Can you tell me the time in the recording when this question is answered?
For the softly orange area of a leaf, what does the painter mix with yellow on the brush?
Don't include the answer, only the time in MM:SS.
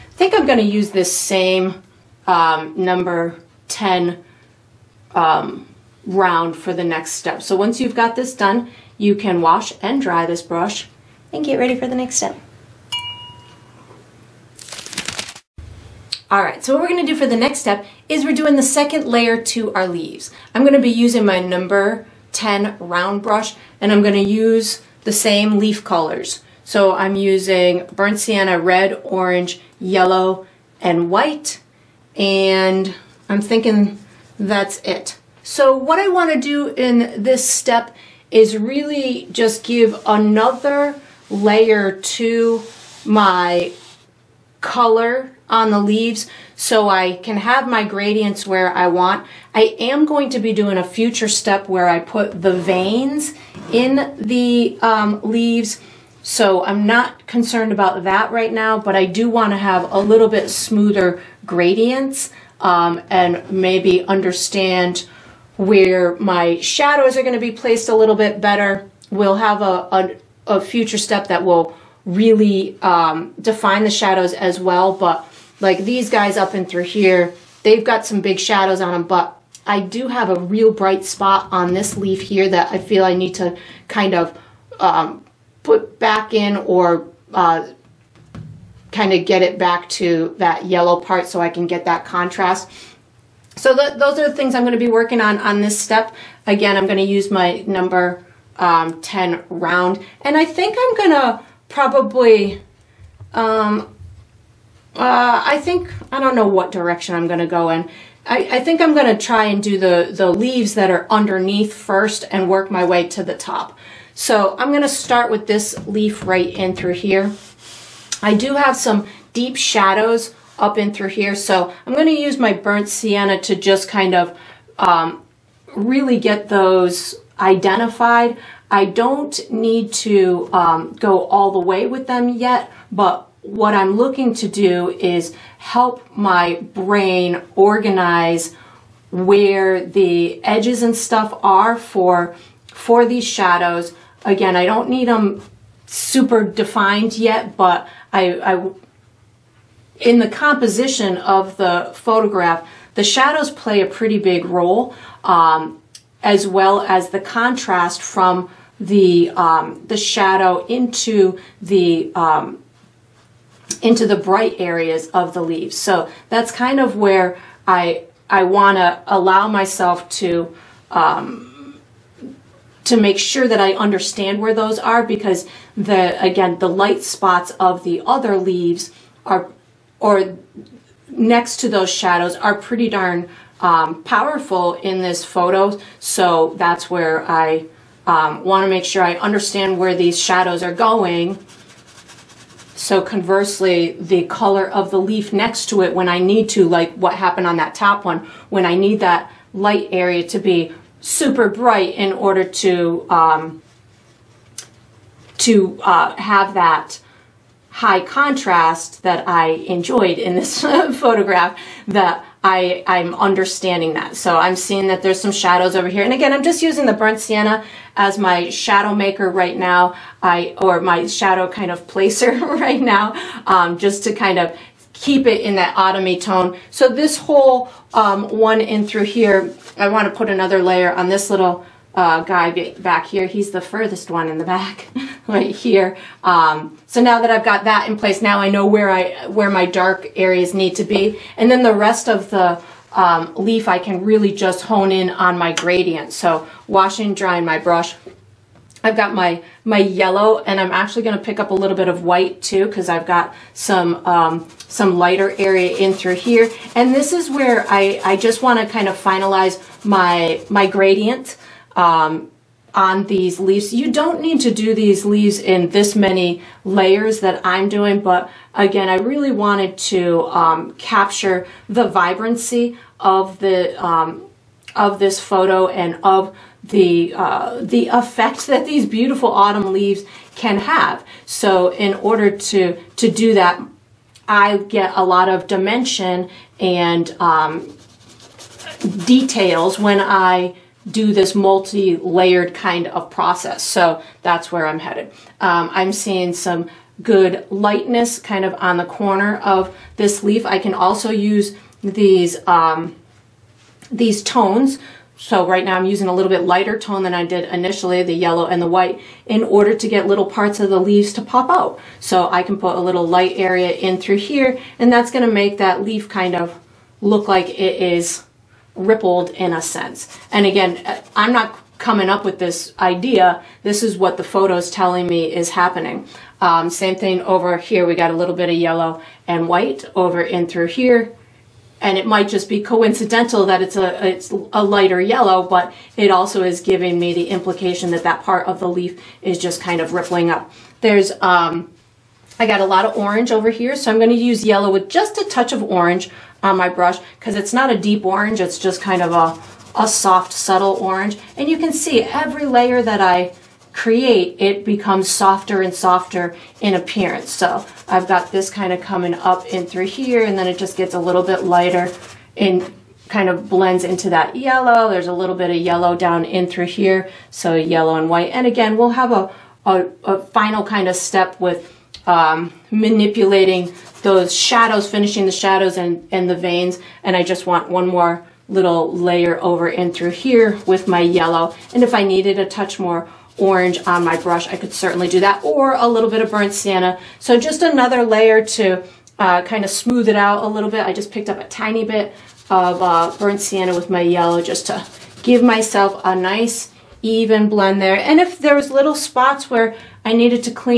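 05:44.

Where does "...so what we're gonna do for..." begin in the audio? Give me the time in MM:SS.
00:16.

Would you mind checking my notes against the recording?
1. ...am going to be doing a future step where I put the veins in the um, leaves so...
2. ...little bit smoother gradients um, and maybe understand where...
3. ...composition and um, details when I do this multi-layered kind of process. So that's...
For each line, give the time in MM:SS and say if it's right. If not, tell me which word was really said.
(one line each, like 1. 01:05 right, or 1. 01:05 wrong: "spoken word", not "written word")
1. 00:49 right
2. 00:59 right
3. 04:45 wrong: "dimension", not "composition".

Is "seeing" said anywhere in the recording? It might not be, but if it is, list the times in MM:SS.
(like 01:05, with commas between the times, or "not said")
03:34, 04:55.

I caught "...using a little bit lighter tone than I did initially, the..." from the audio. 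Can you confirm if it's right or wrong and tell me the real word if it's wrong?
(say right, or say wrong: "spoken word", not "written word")
right.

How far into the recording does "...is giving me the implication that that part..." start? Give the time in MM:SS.
05:36.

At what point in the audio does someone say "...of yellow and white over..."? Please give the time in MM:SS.
05:28.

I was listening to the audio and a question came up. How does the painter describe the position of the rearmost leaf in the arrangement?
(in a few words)
furthest one in the back.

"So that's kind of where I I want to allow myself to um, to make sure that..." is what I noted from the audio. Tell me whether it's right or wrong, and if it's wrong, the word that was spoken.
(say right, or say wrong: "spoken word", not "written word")
right.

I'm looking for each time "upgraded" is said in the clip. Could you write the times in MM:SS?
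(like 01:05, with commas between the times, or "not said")
not said.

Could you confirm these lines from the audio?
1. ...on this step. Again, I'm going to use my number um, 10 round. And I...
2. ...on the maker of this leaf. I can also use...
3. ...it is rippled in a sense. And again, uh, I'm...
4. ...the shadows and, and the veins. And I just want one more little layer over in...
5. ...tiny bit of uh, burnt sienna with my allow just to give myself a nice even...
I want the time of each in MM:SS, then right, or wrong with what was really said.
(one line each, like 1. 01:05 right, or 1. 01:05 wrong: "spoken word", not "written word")
1. 01:35 right
2. 04:58 wrong: "corner", not "maker"
3. 05:17 right
4. 06:15 right
5. 06:31 wrong: "yellow", not "allow".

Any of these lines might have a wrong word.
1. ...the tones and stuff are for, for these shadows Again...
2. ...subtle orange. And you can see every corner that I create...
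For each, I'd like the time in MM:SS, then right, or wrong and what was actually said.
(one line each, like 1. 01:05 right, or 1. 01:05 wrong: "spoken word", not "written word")
1. 02:19 wrong: "edges", not "tones"
2. 05:50 wrong: "layer", not "corner".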